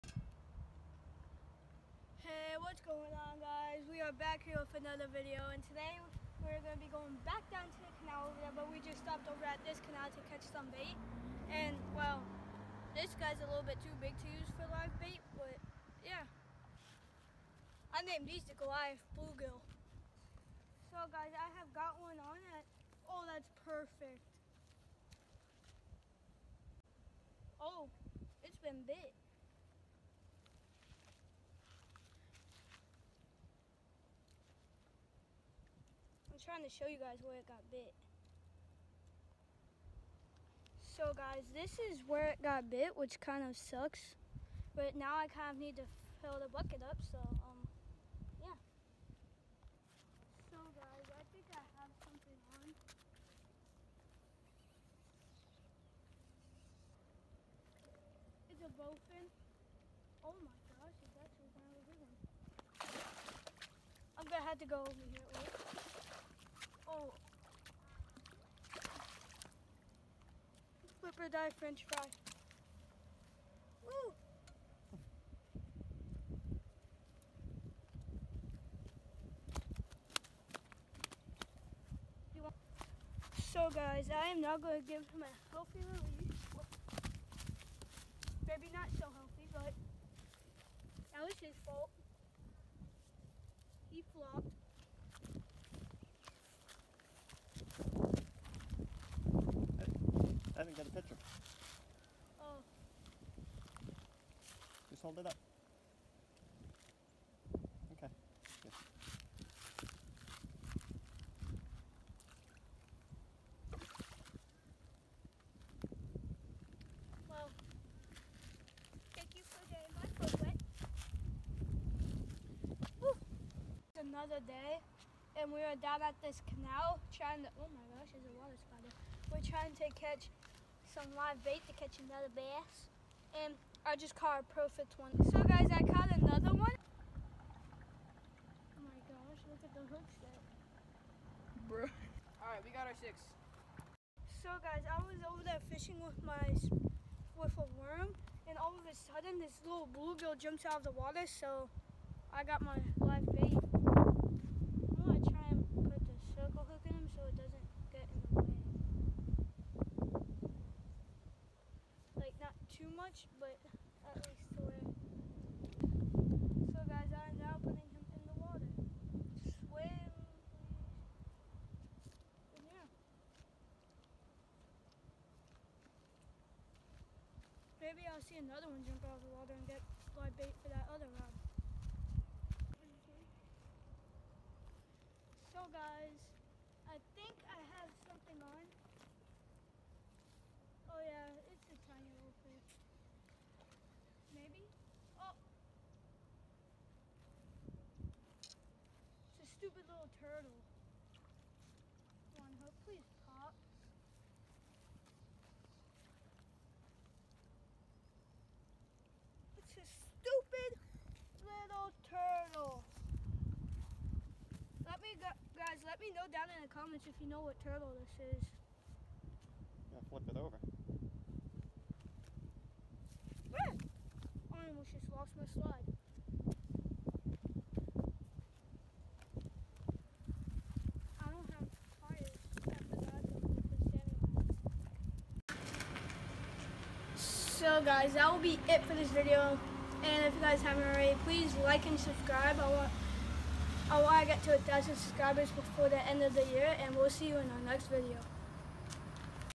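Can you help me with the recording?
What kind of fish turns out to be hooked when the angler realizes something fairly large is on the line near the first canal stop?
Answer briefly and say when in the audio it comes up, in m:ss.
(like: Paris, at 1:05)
Bowfin, at 0:58.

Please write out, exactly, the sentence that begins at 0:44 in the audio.
But now I kind of need to fill the bucket up, so um, yeah.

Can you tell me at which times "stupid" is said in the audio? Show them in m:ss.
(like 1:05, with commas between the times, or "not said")
3:19.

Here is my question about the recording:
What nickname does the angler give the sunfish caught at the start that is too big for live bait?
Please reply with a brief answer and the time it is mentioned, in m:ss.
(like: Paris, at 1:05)
Goliath Bluegill, at 0:18.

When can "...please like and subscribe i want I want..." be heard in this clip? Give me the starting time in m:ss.
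4:01.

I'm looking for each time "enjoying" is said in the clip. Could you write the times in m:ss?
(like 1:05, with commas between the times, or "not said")
not said.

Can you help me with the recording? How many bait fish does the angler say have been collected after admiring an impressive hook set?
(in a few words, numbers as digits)
6.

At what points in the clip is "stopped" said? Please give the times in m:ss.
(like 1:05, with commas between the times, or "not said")
0:09.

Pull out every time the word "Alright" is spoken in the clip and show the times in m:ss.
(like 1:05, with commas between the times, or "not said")
2:22.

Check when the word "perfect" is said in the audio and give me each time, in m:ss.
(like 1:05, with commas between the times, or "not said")
0:23, 2:14.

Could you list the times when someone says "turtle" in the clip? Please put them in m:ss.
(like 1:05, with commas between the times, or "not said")
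3:20, 3:37.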